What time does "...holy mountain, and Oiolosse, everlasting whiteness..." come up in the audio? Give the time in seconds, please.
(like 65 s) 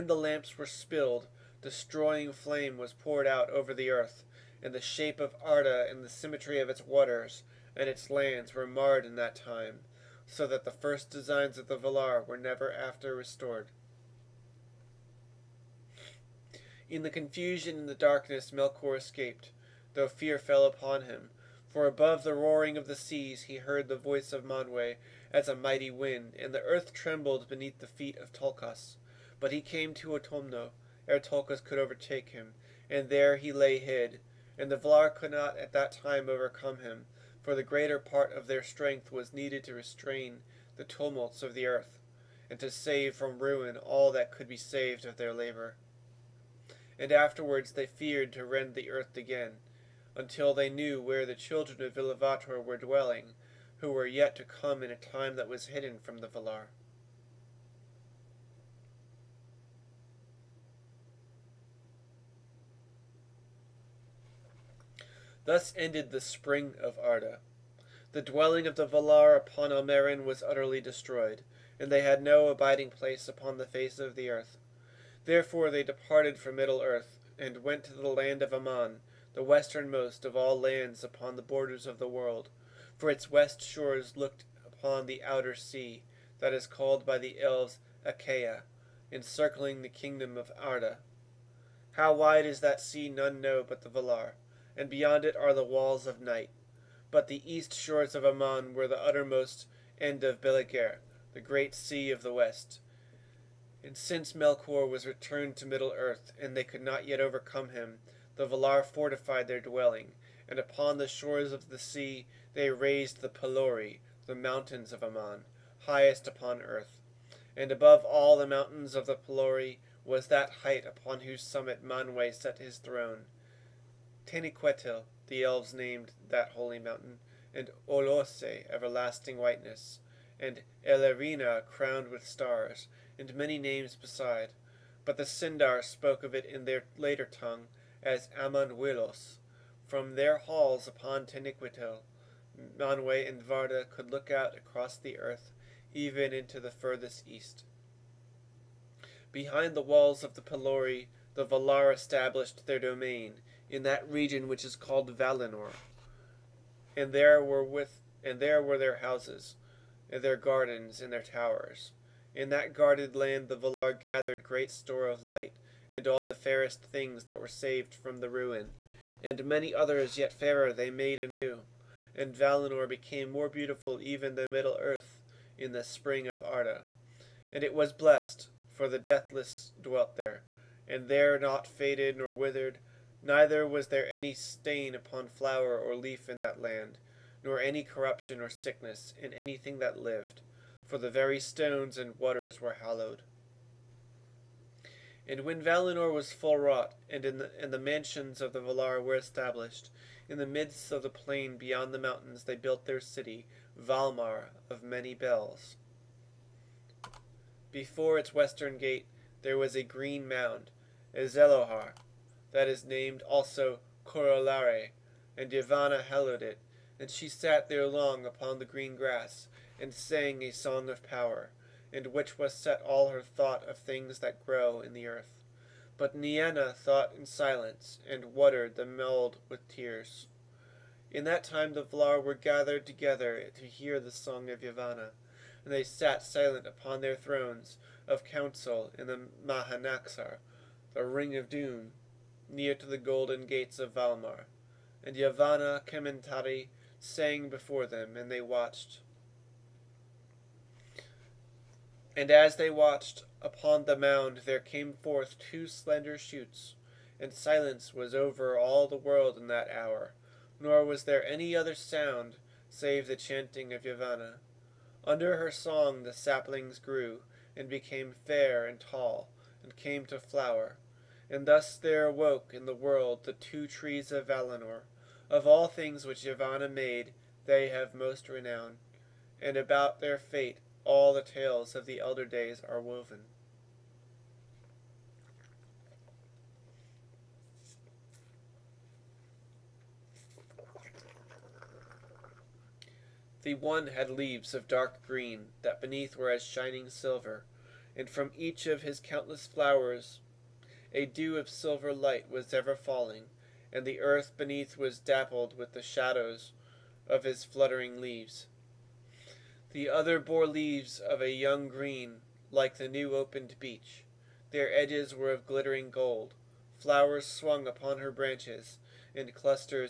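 126 s.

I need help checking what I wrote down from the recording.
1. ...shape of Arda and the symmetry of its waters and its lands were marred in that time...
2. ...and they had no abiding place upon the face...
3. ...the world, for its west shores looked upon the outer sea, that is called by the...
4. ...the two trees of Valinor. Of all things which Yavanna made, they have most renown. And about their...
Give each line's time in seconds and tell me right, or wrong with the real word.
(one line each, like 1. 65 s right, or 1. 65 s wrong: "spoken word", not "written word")
1. 4 s right
2. 71 s right
3. 81 s right
4. 273 s right.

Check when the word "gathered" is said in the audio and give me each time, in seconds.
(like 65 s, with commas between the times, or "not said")
164 s, 232 s.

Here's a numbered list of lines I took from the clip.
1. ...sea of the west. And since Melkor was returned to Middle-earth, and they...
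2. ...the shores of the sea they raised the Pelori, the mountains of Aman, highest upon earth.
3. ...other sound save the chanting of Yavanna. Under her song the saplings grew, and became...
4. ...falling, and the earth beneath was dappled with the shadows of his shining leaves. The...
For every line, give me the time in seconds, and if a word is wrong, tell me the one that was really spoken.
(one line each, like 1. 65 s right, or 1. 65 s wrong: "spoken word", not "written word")
1. 101 s right
2. 110 s right
3. 261 s right
4. 302 s wrong: "fluttering", not "shining".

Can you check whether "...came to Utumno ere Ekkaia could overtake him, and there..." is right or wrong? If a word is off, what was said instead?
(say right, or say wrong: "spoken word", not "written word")
wrong: "Tulkas", not "Ekkaia".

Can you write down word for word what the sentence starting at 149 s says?
Behind the walls of the Pelori, the Valar established their domain in that region which is called Valinor.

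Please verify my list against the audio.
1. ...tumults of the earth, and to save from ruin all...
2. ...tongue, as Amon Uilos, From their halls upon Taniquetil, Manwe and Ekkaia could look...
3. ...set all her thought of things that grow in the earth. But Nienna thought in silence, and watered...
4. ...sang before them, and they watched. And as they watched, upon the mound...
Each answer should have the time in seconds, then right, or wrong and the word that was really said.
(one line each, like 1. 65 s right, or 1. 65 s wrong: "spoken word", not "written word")
1. 40 s right
2. 137 s wrong: "Varda", not "Ekkaia"
3. 222 s right
4. 246 s right.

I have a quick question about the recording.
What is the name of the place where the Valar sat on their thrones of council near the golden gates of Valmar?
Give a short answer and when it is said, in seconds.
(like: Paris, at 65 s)
Mahanaxar, at 239 s.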